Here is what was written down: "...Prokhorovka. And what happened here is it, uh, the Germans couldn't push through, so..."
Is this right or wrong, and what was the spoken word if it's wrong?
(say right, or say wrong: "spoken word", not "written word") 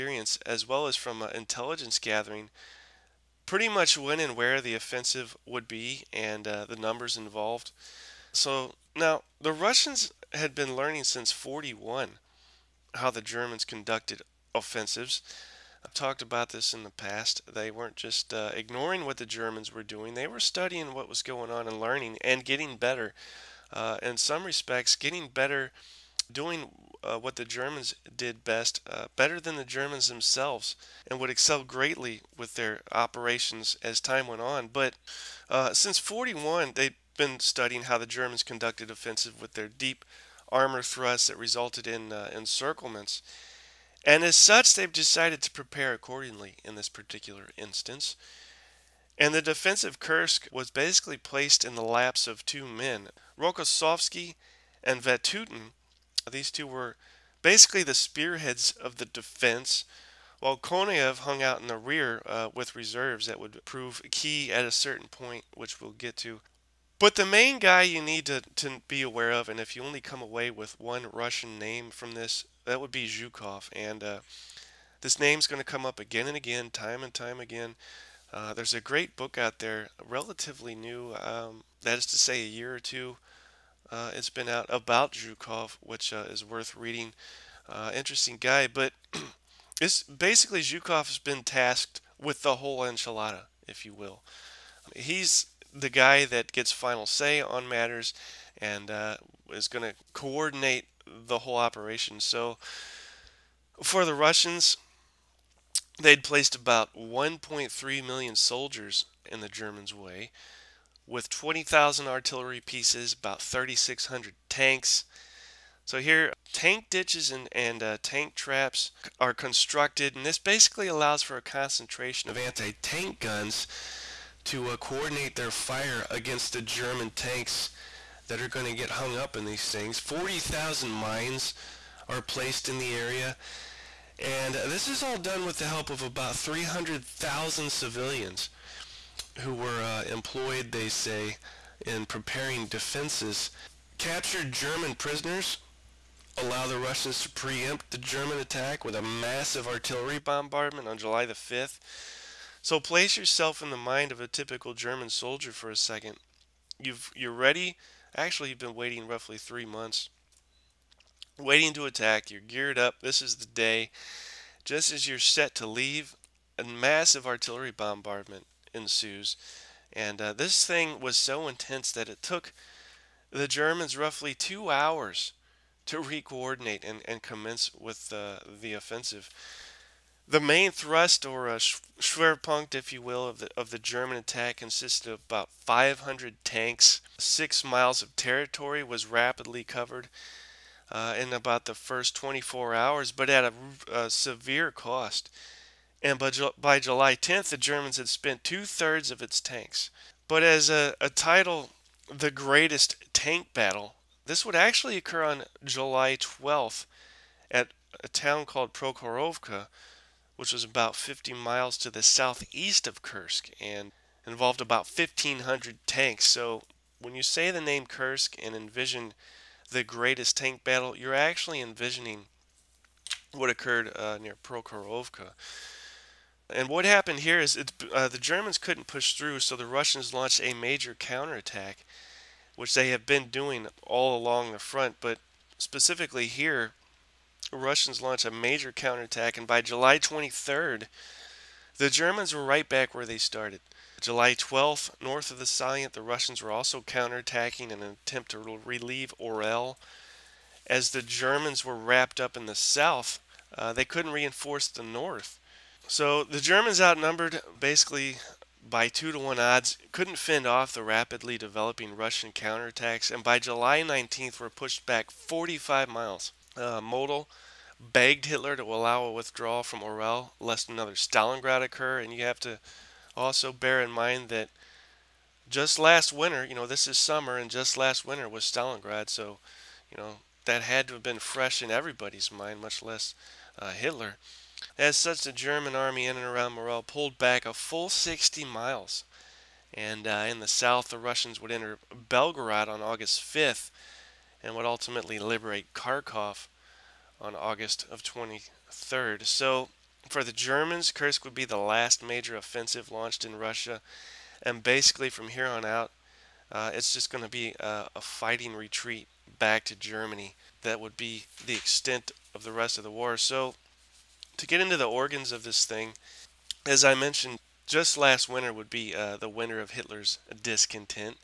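right.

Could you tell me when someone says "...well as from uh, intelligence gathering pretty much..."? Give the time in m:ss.
0:00.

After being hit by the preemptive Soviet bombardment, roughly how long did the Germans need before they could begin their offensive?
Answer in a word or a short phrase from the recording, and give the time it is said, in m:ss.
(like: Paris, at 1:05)
2 hours, at 2:54.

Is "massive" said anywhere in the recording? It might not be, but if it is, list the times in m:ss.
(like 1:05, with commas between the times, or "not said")
2:29, 2:46.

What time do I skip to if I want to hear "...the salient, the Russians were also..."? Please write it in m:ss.
4:05.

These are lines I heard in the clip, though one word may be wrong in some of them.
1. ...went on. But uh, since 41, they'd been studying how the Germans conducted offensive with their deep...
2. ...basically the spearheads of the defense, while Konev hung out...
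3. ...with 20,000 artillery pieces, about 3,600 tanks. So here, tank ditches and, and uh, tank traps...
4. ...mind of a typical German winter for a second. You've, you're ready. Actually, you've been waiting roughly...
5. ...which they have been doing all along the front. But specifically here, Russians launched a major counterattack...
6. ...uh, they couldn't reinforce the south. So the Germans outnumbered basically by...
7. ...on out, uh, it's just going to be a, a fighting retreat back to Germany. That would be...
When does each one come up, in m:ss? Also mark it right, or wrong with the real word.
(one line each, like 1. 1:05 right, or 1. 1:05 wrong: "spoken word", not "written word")
1. 0:34 right
2. 0:57 right
3. 1:51 right
4. 2:33 wrong: "soldier", not "winter"
5. 3:52 right
6. 4:13 wrong: "north", not "south"
7. 5:05 right.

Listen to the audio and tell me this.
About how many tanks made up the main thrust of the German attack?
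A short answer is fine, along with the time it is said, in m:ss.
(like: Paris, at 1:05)
500, at 3:05.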